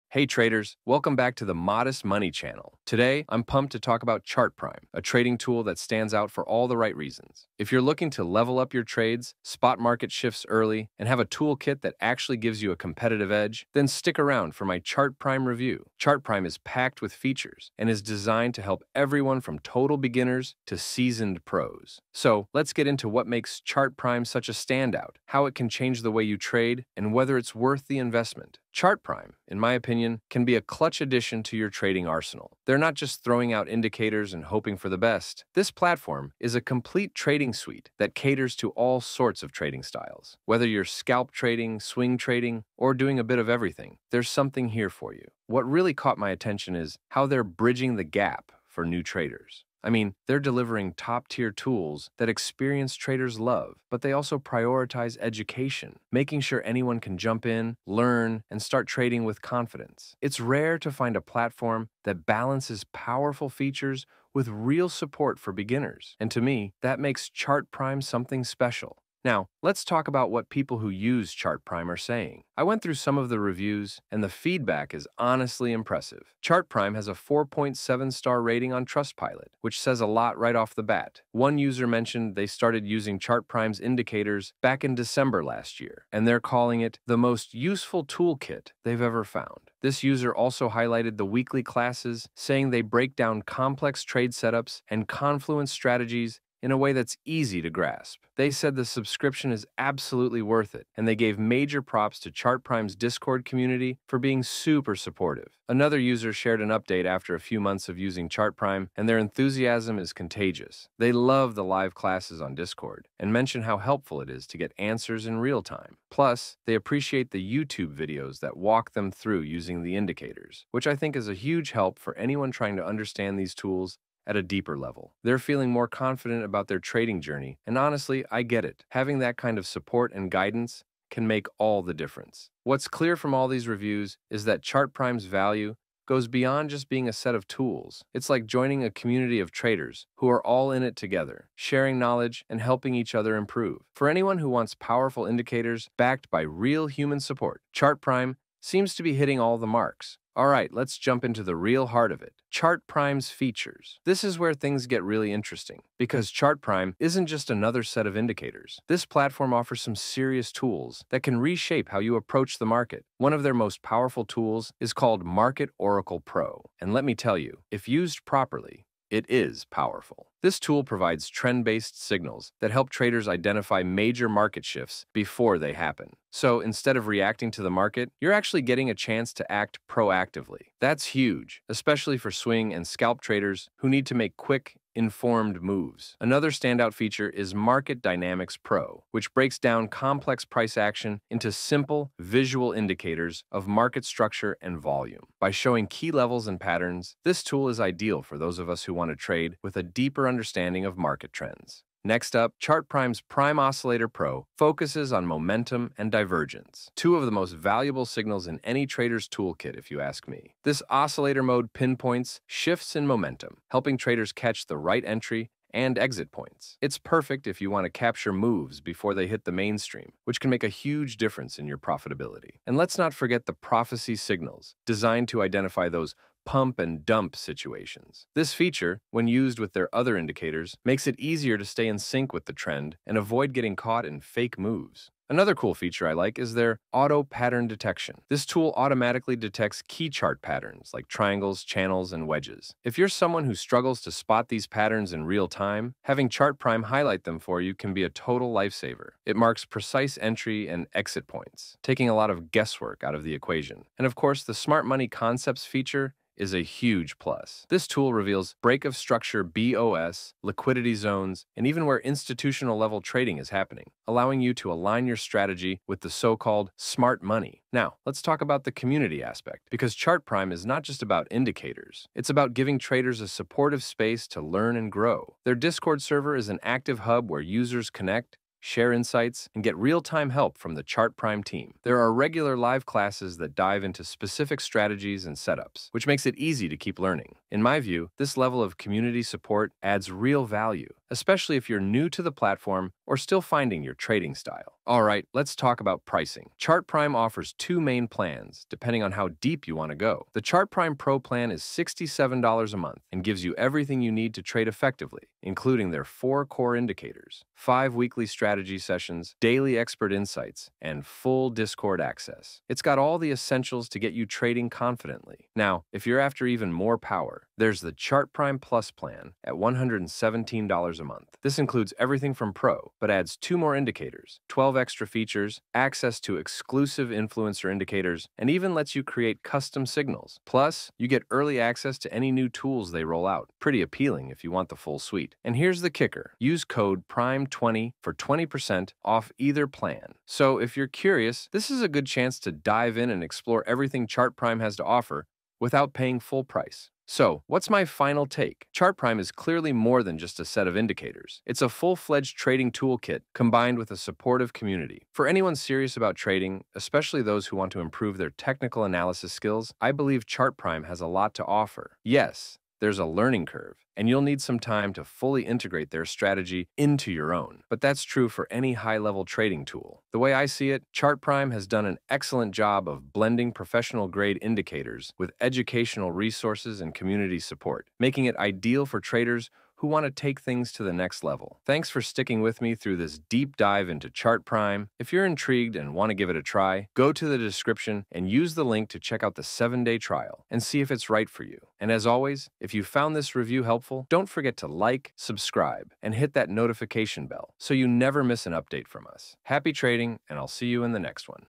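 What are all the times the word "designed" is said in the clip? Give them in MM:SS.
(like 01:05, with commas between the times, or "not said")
00:18, 03:44.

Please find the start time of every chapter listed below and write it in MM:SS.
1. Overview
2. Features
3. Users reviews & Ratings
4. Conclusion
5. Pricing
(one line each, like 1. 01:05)
1. 00:33
2. 02:35
3. 01:14
4. 05:52
5. 05:00.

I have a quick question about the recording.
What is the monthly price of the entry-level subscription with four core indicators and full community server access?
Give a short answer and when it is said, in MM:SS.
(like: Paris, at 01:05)
$67, at 05:01.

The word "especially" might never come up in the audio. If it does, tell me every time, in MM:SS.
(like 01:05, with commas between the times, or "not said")
03:01, 04:51, 05:56.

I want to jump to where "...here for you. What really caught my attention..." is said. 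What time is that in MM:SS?
00:44.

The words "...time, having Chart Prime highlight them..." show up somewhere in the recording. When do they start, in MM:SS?
04:05.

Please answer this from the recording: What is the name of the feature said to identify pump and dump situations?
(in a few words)
prophecy signals.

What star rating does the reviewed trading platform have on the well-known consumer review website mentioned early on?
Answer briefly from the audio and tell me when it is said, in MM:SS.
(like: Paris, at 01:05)
4.7, at 01:17.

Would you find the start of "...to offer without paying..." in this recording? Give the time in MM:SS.
05:44.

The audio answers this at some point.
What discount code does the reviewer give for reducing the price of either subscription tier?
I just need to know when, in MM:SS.
05:37.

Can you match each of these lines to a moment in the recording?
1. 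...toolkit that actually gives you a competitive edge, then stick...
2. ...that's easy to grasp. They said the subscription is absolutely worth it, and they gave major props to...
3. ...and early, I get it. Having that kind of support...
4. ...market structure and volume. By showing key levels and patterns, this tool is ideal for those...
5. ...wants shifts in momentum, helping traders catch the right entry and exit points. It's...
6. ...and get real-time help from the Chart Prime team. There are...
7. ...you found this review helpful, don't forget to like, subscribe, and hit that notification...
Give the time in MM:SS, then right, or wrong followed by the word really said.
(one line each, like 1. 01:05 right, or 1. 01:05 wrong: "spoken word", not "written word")
1. 00:11 right
2. 01:36 right
3. 02:07 wrong: "honestly", not "early"
4. 03:13 right
5. 03:31 wrong: "pinpoints", not "wants"
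6. 04:39 right
7. 06:32 right.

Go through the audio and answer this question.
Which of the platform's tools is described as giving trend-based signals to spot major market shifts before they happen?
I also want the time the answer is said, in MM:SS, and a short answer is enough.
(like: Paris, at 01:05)
Market Oracle Pro, at 02:45.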